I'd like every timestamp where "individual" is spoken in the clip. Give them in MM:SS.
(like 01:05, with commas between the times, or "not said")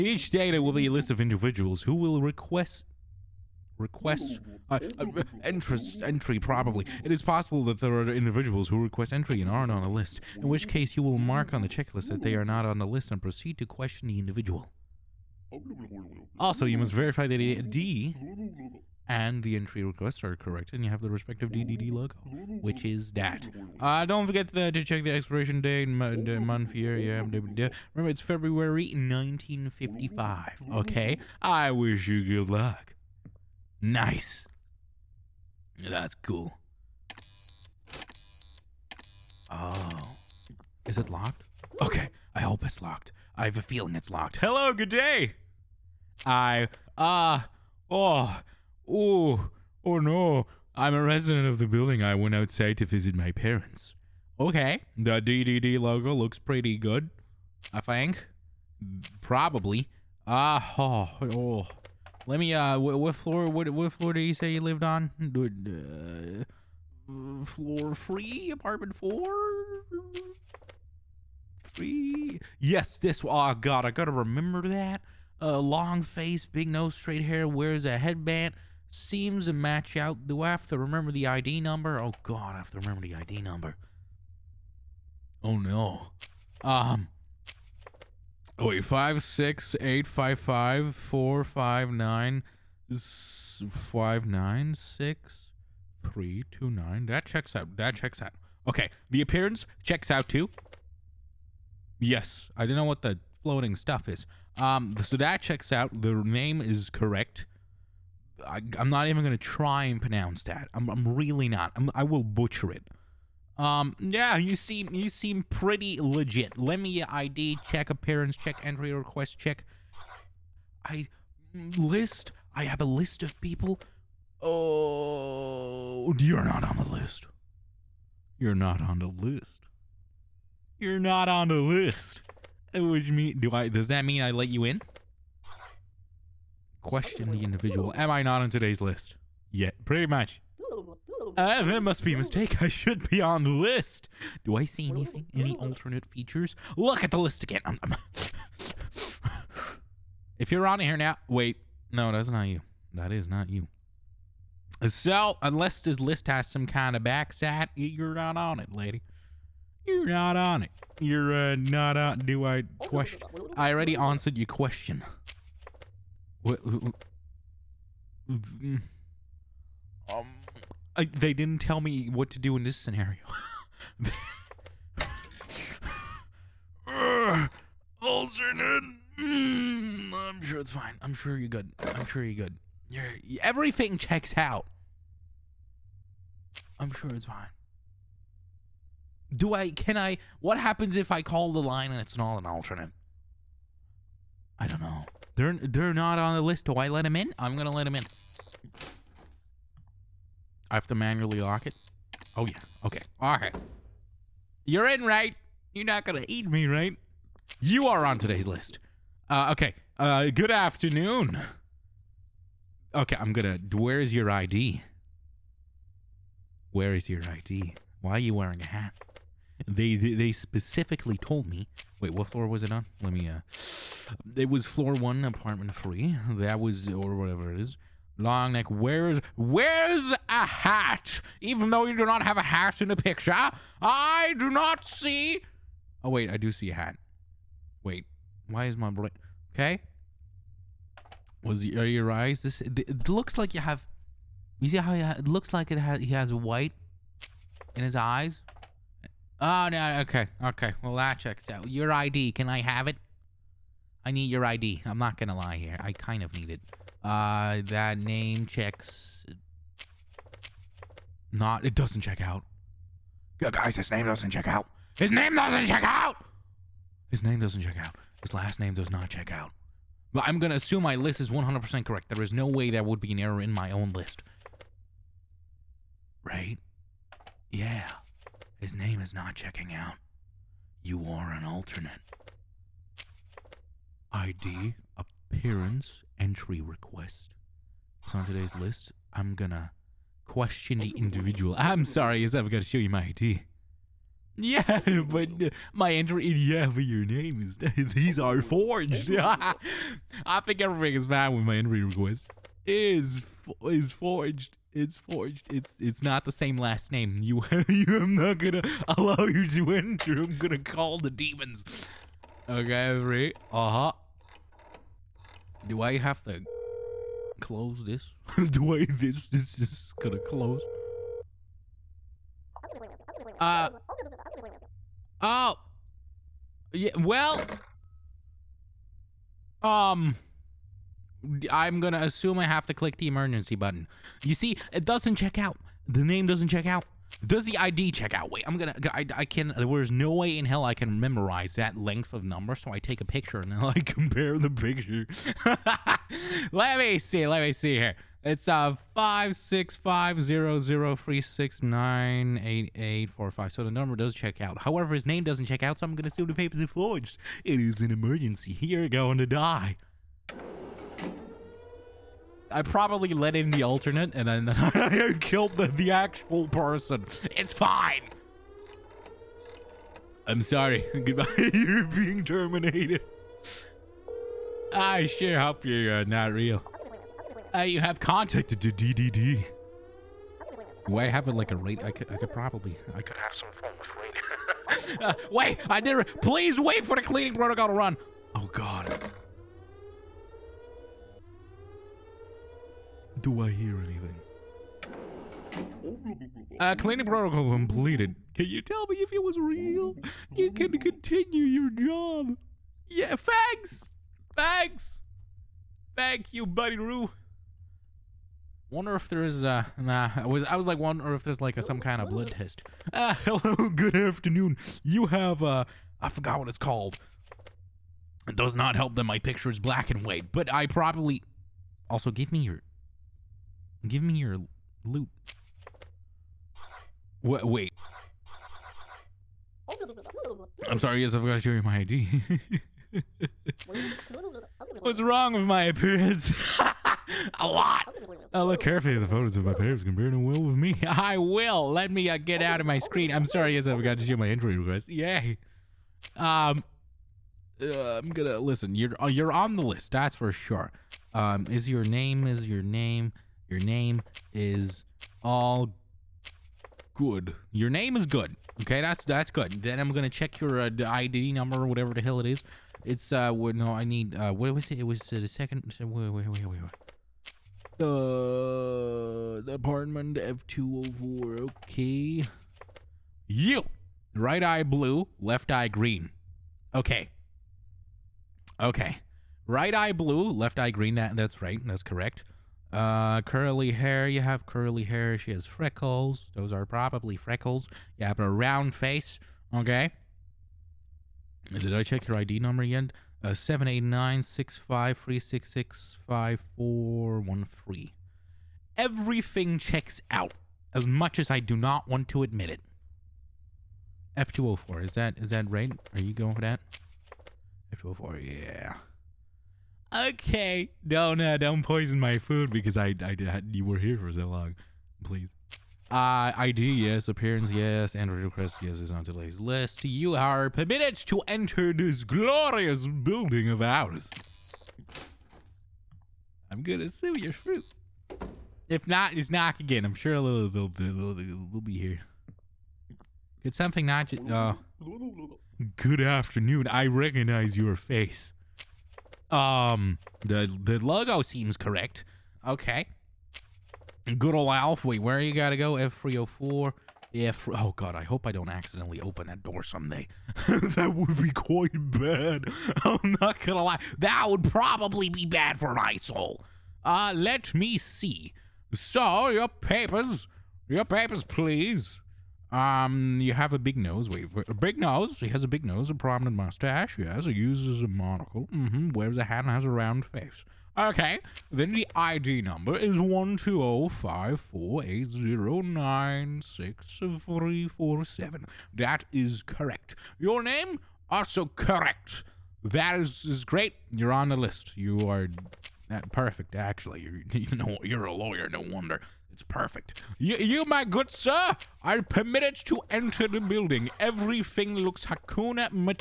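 00:01, 00:08, 00:14, 02:17, 04:50.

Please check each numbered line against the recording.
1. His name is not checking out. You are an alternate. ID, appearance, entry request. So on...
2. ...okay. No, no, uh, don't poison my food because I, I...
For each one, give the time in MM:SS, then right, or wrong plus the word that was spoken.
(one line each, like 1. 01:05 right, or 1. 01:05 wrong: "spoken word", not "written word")
1. 04:38 right
2. 08:29 right.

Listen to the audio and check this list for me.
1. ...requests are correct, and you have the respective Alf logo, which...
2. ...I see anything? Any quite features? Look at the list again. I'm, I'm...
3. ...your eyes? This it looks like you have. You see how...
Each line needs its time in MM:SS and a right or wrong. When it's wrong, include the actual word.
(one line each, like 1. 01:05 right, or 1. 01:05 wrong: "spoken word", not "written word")
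1. 00:19 wrong: "DDD", not "Alf"
2. 02:24 wrong: "alternate", not "quite"
3. 04:01 right.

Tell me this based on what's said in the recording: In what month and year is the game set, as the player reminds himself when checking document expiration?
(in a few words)
February 1955.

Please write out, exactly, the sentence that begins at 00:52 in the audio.
I went outside to visit my parents.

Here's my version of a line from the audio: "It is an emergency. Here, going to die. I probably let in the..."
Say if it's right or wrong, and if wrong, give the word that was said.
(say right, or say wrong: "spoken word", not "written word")
right.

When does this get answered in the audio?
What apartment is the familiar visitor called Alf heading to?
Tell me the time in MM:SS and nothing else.
09:05.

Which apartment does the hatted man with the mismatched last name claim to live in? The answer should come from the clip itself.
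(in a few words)
Floor 1, apartment 3.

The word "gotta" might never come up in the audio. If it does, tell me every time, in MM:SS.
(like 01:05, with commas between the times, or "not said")
01:13, 09:05.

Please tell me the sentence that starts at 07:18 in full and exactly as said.
I look carefully at the photos of my parents compared to Will with me.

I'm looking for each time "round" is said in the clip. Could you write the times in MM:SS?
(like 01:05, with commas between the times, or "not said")
08:08, 09:29.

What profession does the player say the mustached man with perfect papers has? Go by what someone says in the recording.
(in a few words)
lawyer.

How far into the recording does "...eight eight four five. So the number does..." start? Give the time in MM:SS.
05:52.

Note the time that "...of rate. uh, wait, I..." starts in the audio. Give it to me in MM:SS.
06:23.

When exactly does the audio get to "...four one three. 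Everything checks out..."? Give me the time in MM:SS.
08:16.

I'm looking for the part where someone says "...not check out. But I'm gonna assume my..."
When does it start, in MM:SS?
04:28.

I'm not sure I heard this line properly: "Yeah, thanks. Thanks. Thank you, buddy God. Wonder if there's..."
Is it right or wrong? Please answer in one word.
wrong.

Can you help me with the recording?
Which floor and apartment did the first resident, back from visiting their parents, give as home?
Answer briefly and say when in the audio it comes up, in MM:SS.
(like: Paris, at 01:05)
Floor 3, apartment 4, at 01:07.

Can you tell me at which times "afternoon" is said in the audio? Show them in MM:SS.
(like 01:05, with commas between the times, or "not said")
03:30, 06:53, 08:56.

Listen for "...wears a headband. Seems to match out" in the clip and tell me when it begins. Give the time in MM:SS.
01:17.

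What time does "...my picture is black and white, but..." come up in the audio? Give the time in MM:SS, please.
06:59.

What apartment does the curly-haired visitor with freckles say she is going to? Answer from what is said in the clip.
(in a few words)
F204.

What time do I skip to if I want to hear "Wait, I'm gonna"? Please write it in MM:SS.
05:38.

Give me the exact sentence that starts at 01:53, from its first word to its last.
Um, yeah, you seem you seem pretty legit.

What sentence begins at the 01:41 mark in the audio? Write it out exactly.
Yes, I don't know what the floating stuff is.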